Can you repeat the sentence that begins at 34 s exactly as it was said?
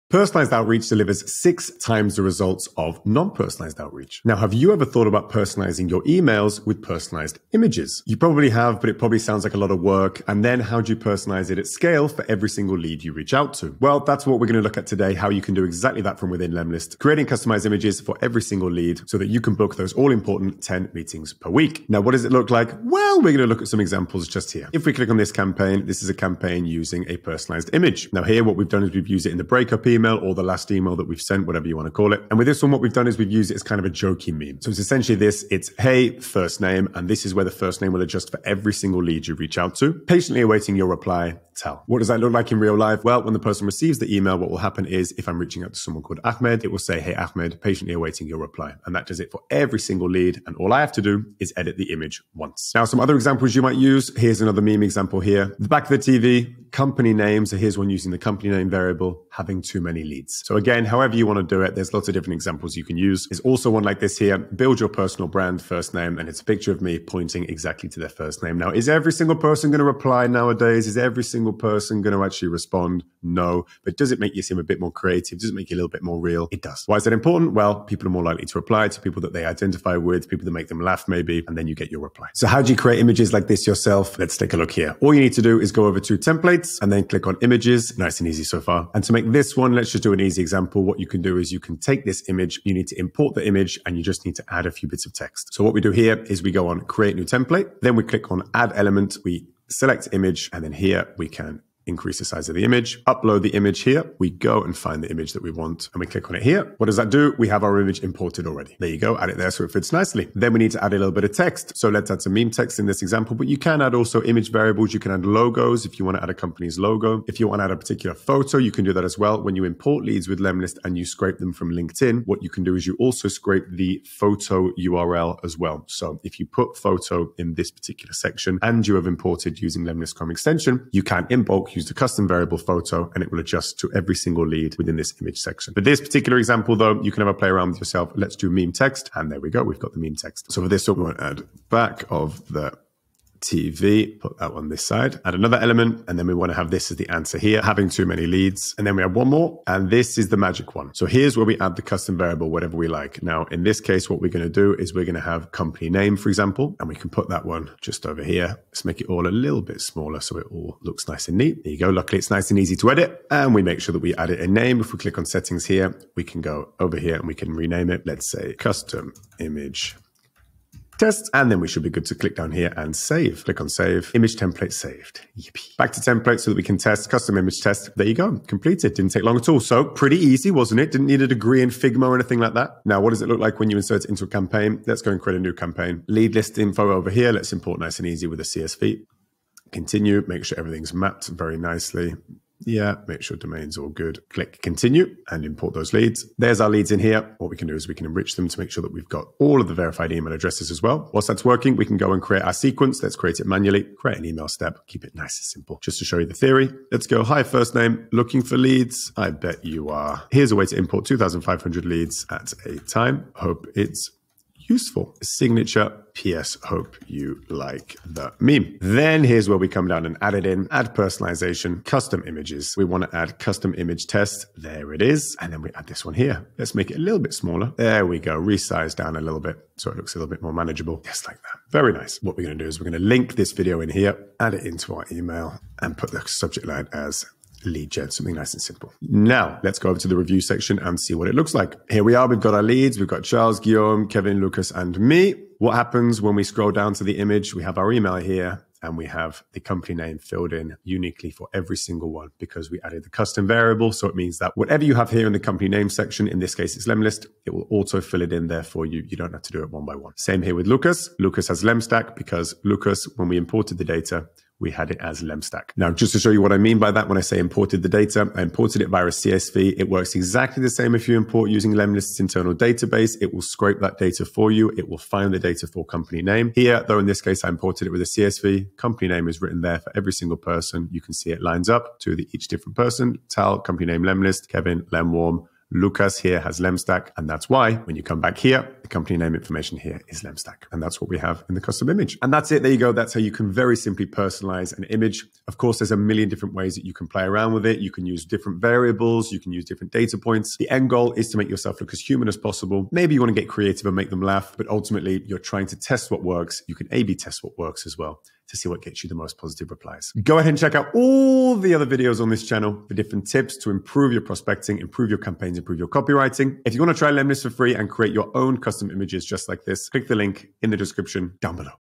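So it's essentially this, it's, hey, first name.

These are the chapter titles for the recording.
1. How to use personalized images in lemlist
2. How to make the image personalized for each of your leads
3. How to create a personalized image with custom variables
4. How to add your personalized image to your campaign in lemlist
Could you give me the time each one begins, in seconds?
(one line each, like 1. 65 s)
1. 22 s
2. 239 s
3. 82 s
4. 183 s.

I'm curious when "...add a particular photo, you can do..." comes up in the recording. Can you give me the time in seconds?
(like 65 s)
117 s.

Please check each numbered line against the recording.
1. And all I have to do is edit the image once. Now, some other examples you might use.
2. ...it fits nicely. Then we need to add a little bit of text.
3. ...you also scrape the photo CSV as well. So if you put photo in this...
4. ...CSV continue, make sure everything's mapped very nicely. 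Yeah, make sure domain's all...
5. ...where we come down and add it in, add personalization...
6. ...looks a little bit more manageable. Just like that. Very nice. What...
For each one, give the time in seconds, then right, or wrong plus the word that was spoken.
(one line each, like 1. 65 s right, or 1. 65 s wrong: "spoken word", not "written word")
1. 50 s right
2. 109 s right
3. 122 s wrong: "URL", not "CSV"
4. 188 s right
5. 219 s right
6. 229 s right.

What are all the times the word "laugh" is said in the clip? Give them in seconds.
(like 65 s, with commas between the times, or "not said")
80 s, 304 s.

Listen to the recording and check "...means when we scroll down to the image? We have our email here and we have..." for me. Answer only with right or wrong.
wrong.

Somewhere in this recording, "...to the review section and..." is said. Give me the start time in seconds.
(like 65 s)
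239 s.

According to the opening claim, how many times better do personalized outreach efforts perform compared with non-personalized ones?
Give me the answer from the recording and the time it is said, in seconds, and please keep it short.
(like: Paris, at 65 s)
6, at 1 s.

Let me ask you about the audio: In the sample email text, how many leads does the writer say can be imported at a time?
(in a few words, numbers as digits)
2,500.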